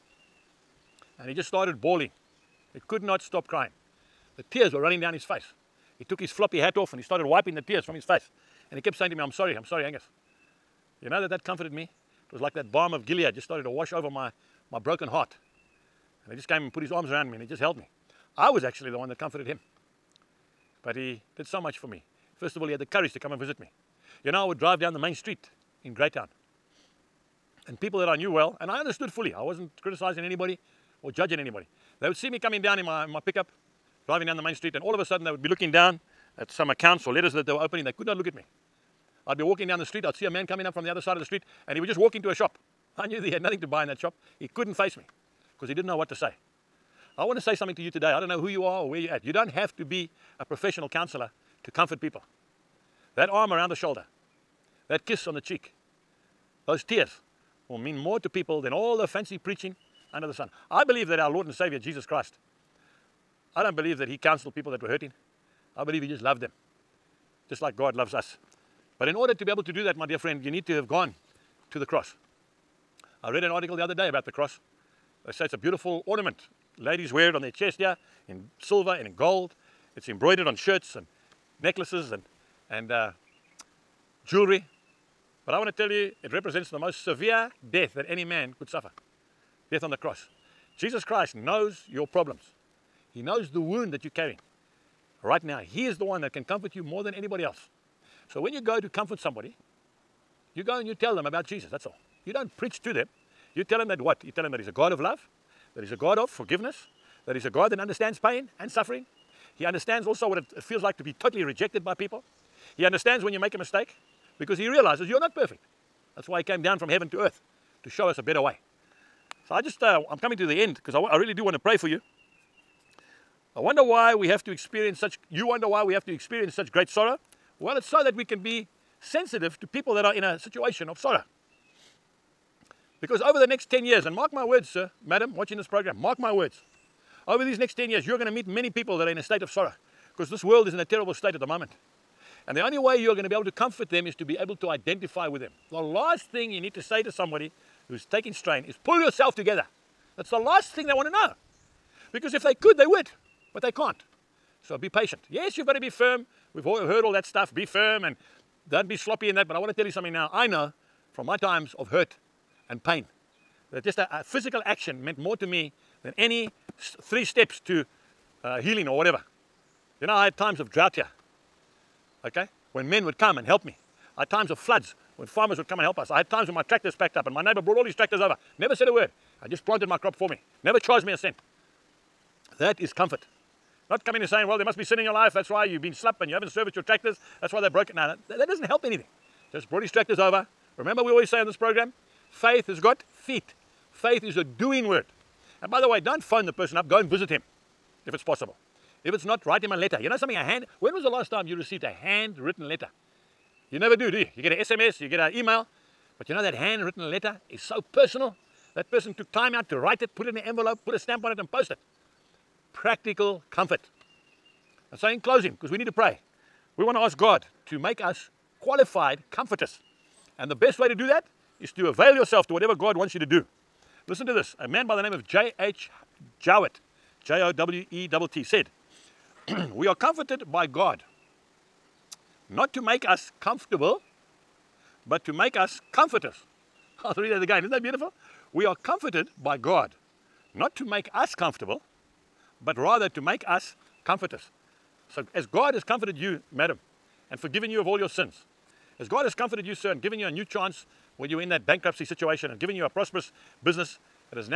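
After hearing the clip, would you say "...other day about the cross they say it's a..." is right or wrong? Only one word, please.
right.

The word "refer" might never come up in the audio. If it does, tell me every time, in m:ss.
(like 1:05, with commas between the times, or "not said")
not said.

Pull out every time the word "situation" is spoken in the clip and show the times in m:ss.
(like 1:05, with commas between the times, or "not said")
2:10, 4:12.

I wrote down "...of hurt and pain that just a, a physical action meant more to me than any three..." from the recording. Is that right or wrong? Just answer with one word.
right.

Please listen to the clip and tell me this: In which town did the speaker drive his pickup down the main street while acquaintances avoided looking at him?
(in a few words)
Greytown.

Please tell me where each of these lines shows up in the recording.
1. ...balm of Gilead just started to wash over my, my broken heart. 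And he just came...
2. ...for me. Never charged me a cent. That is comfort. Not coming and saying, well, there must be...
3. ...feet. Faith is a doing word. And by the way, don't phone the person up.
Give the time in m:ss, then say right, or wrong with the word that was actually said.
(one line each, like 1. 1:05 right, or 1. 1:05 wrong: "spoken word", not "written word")
1. 0:12 right
2. 3:00 right
3. 3:13 right.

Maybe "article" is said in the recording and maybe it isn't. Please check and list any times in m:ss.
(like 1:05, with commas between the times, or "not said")
1:13.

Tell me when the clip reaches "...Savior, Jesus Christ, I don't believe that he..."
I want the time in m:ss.
1:01.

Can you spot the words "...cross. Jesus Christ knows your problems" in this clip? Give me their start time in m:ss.
1:29.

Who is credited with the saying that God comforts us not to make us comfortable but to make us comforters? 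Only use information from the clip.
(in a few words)
J.H. Jowett.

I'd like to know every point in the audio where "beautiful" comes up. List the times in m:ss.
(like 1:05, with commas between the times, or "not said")
1:15, 3:57.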